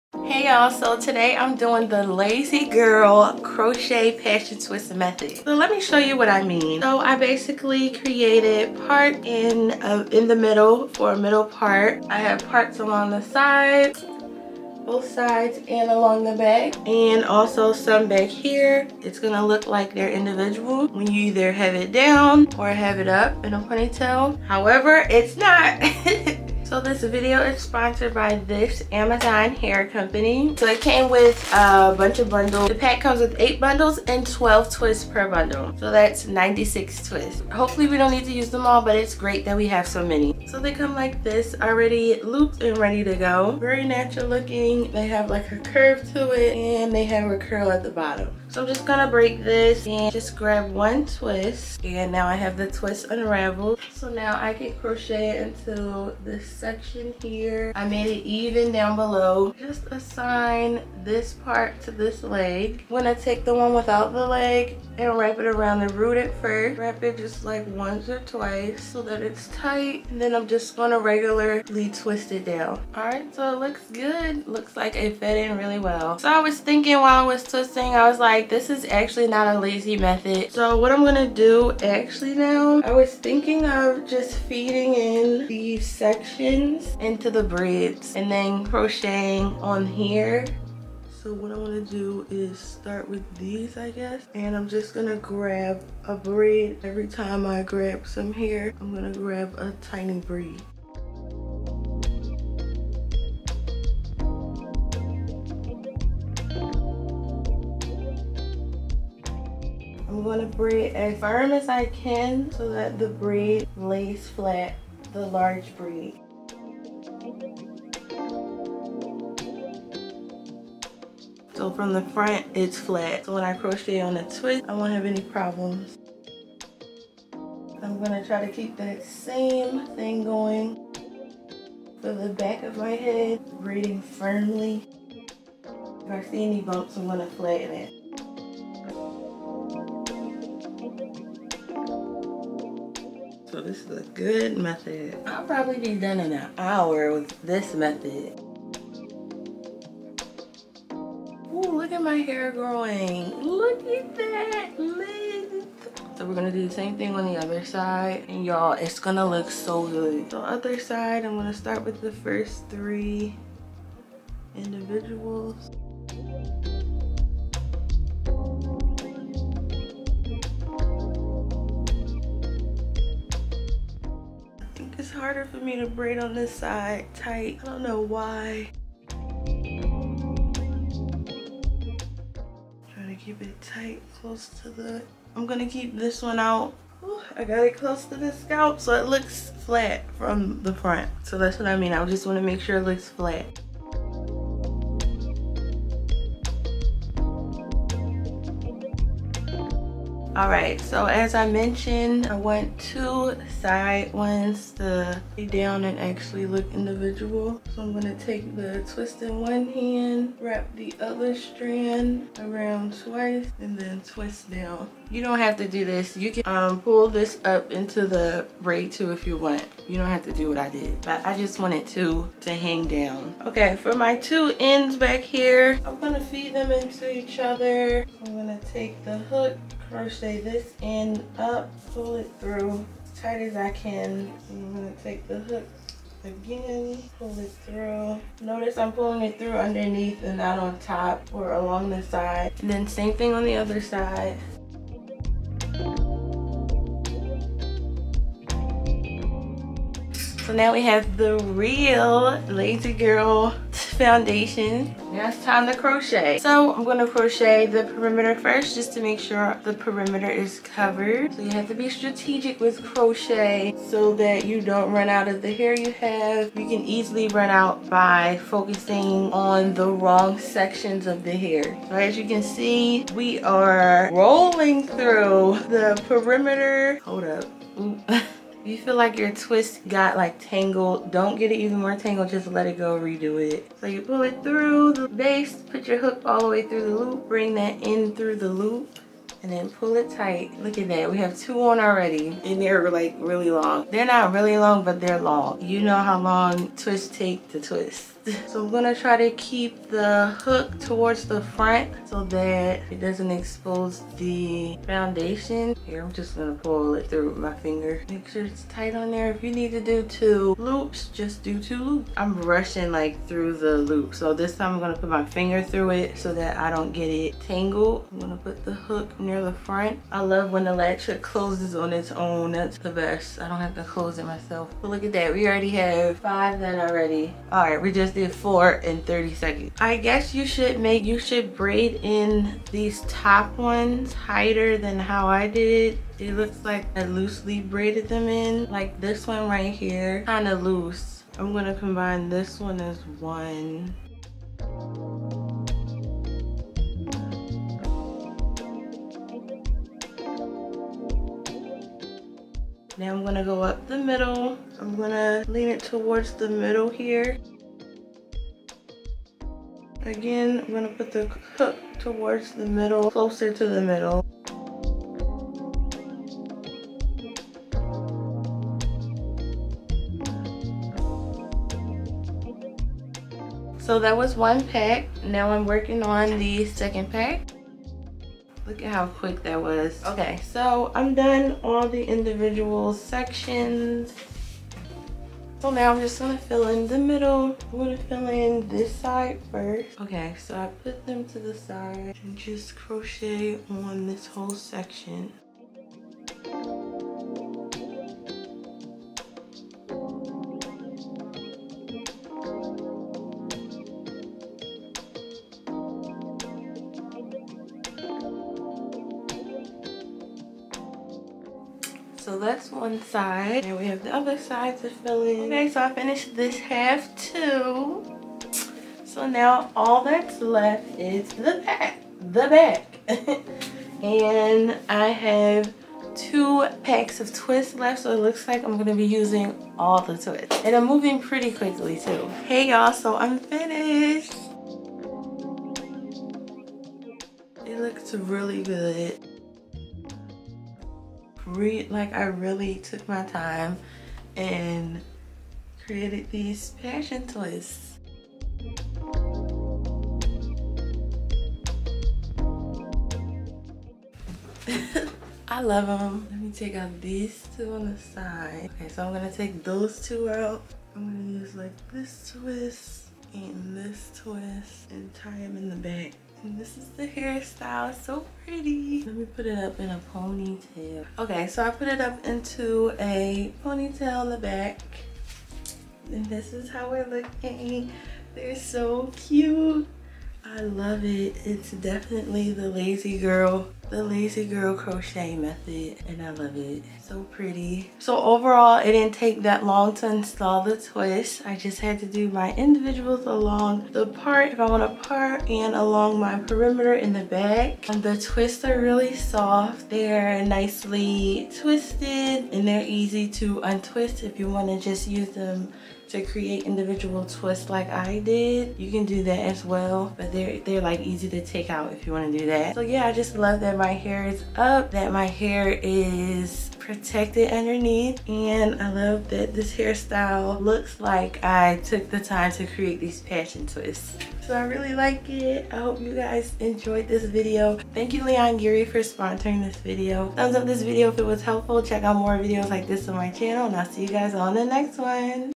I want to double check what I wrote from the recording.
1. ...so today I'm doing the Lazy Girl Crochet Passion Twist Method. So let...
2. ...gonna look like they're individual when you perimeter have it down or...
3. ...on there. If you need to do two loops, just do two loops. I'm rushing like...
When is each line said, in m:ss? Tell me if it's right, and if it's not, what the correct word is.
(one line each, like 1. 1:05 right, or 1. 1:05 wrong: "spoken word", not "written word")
1. 0:00 right
2. 0:19 wrong: "either", not "perimeter"
3. 5:08 right.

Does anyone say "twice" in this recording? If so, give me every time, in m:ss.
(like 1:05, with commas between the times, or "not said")
1:08, 3:33.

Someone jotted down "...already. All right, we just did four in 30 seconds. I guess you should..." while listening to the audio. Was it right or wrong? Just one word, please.
right.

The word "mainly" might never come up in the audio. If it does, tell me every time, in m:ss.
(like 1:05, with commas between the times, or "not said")
not said.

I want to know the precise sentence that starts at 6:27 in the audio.
I'm gonna fill in this side first.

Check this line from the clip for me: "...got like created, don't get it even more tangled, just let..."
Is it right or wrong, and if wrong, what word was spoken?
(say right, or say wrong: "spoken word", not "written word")
wrong: "tangled", not "created".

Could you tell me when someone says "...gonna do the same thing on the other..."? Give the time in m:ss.
2:36.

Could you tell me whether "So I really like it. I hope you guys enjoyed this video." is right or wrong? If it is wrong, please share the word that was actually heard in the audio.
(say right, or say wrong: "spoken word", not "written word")
right.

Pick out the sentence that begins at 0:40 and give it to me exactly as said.
So they come like this, already looped and ready to go.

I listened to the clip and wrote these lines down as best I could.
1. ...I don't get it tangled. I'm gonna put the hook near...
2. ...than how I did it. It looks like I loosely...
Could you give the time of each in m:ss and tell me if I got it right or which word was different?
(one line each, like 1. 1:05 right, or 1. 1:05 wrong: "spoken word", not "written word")
1. 5:16 right
2. 5:34 right.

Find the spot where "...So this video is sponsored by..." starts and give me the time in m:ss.
0:26.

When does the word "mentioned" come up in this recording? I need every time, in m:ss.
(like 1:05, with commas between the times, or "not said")
3:21.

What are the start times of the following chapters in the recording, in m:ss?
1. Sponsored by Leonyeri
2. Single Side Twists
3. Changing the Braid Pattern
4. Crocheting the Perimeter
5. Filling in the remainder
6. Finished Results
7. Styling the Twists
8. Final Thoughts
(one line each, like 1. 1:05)
1. 0:26
2. 0:50
3. 1:16
4. 4:15
5. 6:25
6. 7:12
7. 7:36
8. 7:58.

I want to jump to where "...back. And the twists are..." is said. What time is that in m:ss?
8:17.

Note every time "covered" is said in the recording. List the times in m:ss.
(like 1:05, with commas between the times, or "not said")
4:20.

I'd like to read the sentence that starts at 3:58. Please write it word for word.
Notice I'm pulling it through underneath and not on top or along the side.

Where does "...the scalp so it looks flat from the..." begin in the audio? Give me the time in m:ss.
3:08.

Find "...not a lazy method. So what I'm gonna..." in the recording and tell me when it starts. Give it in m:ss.
1:19.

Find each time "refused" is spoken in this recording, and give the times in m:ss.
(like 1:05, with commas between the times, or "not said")
not said.